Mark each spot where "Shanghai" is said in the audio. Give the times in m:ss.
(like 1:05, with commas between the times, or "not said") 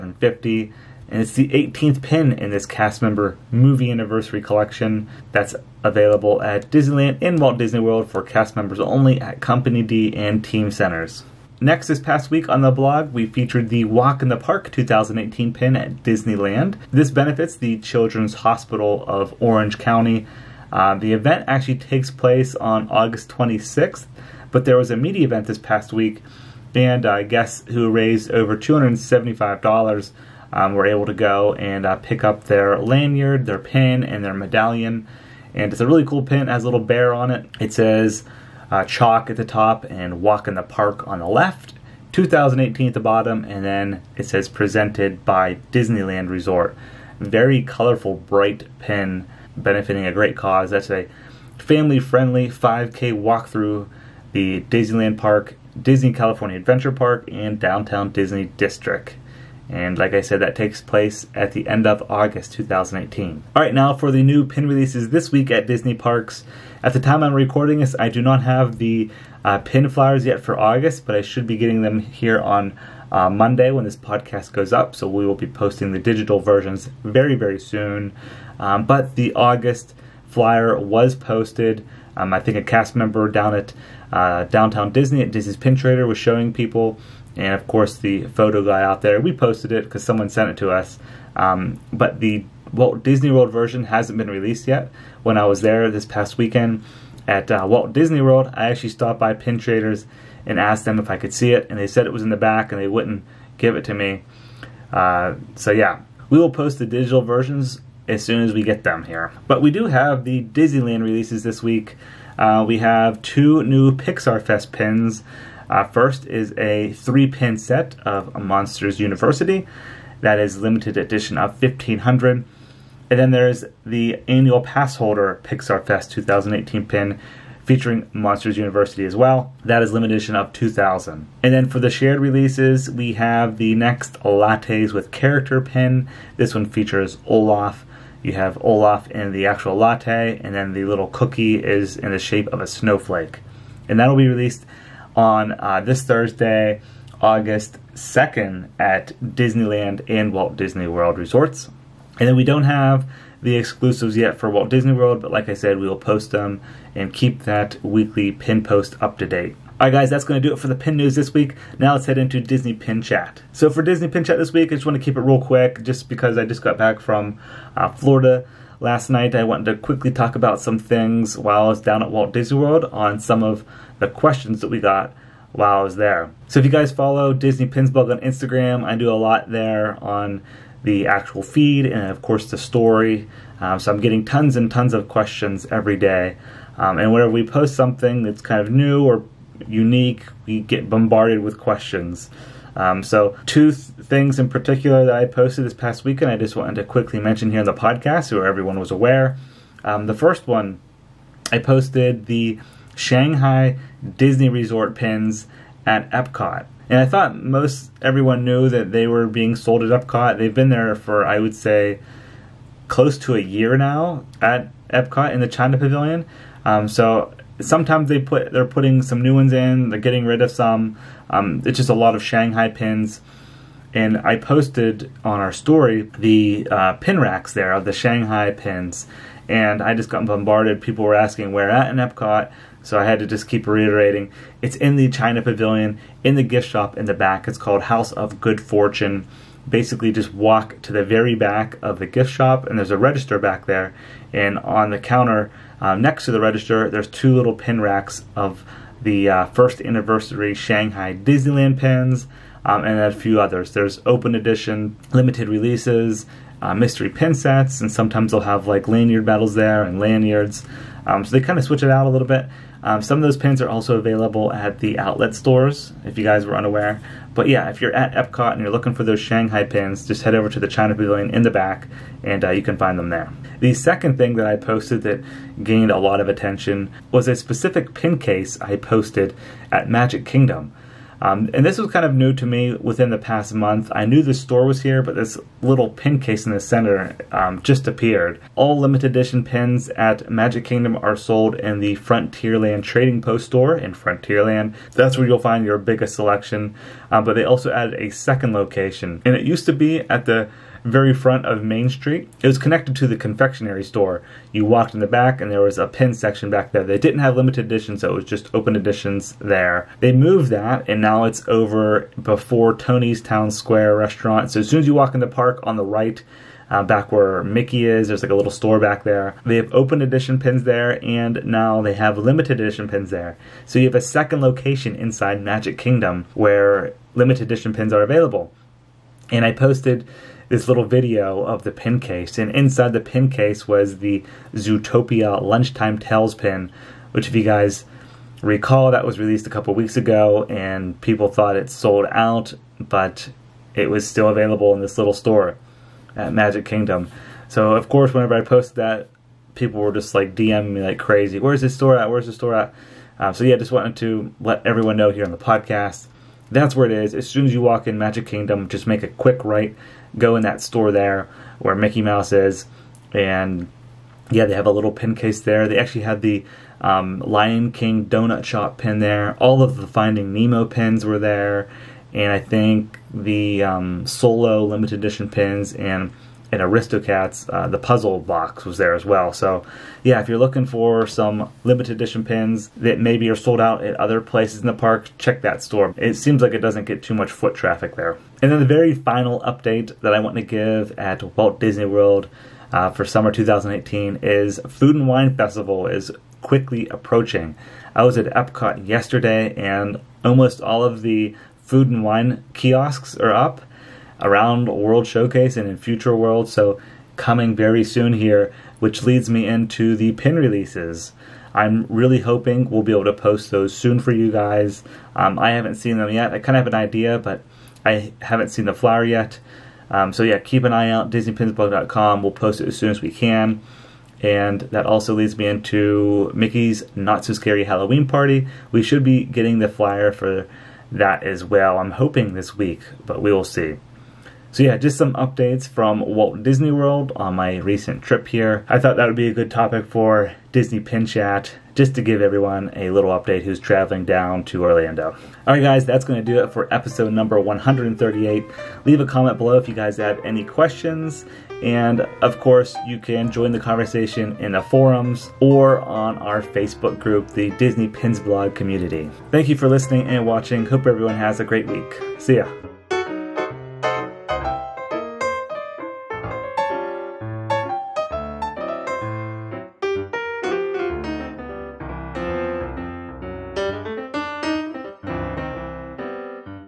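3:22, 3:42, 3:47, 4:10, 4:29.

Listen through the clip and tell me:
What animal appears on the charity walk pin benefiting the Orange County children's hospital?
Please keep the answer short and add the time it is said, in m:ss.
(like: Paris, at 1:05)
Bear, at 0:36.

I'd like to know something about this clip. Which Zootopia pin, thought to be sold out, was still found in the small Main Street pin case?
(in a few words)
Lunchtime Tales.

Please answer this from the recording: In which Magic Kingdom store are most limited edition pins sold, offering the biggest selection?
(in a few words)
Frontierland Trading Post.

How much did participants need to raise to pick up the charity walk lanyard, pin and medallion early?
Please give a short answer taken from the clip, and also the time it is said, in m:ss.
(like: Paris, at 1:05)
$275, at 0:28.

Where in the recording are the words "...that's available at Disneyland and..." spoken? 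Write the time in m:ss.
0:05.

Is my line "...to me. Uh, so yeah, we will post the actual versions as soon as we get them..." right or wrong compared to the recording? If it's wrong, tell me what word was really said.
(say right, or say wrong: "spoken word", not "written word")
wrong: "digital", not "actual".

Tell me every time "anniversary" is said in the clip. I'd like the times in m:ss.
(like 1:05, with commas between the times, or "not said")
0:03, 4:09.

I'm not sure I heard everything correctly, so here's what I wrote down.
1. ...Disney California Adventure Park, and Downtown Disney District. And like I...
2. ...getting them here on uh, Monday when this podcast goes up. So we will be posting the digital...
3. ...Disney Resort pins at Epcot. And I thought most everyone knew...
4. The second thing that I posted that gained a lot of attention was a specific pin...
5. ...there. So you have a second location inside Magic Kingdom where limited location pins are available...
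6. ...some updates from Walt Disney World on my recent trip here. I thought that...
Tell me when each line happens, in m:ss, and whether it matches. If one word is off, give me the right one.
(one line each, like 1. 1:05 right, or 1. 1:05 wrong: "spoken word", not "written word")
1. 0:55 right
2. 1:11 right
3. 3:24 right
4. 4:33 right
5. 5:23 wrong: "edition", not "location"
6. 7:14 right.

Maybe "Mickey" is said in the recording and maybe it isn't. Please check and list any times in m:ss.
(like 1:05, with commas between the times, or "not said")
5:17, 6:01, 7:06.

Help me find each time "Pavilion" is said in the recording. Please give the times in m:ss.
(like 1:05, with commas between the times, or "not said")
3:35, 3:55, 4:30.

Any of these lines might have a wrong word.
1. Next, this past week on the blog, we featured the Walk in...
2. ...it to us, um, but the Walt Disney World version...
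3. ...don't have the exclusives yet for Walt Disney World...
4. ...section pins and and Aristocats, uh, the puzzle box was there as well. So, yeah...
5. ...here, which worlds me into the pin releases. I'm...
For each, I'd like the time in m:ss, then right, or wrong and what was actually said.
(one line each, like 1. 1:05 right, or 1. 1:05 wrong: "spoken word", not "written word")
1. 0:11 right
2. 1:30 right
3. 2:32 right
4. 6:14 wrong: "edition", not "section"
5. 6:48 wrong: "leads", not "worlds".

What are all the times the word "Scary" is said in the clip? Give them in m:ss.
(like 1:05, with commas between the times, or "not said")
7:07.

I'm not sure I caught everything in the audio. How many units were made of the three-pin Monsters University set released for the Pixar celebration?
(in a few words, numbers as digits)
1500.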